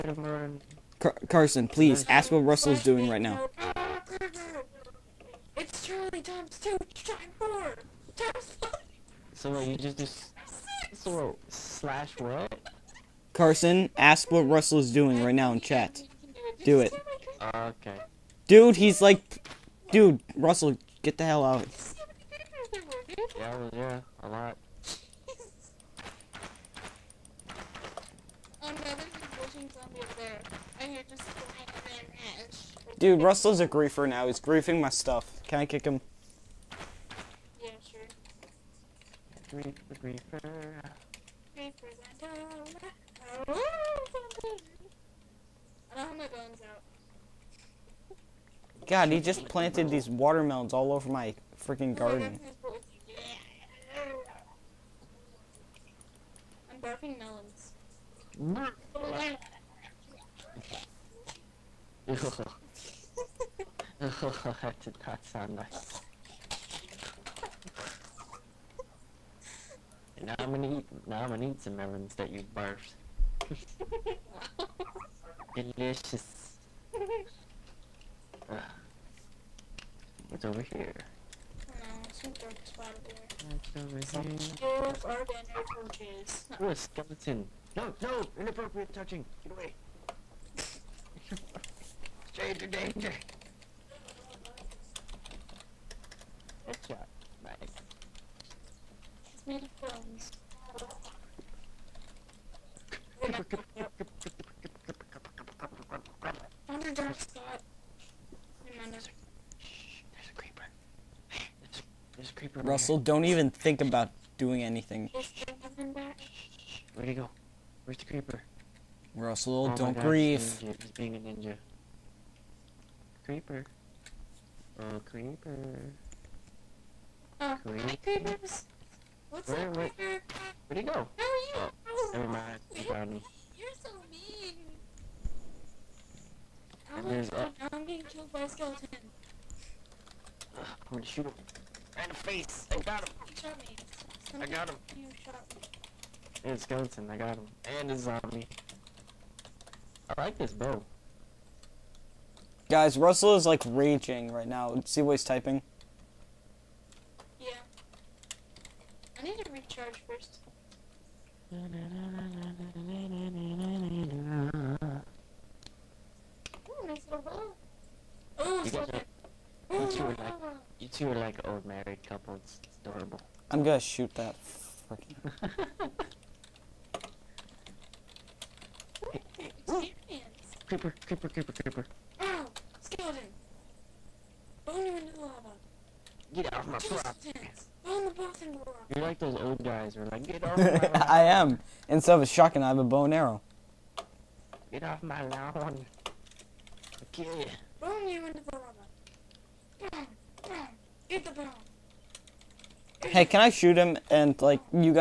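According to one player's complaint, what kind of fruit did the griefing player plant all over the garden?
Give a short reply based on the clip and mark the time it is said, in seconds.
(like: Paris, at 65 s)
watermelons, at 50 s.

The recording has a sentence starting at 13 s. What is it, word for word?
Carson, ask what Russell's doing right now in chat.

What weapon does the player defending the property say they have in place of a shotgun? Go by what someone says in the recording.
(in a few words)
bow and arrow.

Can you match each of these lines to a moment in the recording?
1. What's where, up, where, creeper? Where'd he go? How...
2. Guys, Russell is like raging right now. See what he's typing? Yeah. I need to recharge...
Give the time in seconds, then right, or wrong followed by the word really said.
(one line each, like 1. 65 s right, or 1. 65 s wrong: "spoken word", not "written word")
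1. 129 s right
2. 152 s right.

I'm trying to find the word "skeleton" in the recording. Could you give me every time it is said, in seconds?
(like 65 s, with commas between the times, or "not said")
86 s, 138 s, 146 s.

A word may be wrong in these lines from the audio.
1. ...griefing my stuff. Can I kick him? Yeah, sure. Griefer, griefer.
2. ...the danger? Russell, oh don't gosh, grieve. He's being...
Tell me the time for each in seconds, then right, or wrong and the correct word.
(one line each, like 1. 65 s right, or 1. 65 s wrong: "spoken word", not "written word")
1. 34 s right
2. 117 s wrong: "creeper", not "danger".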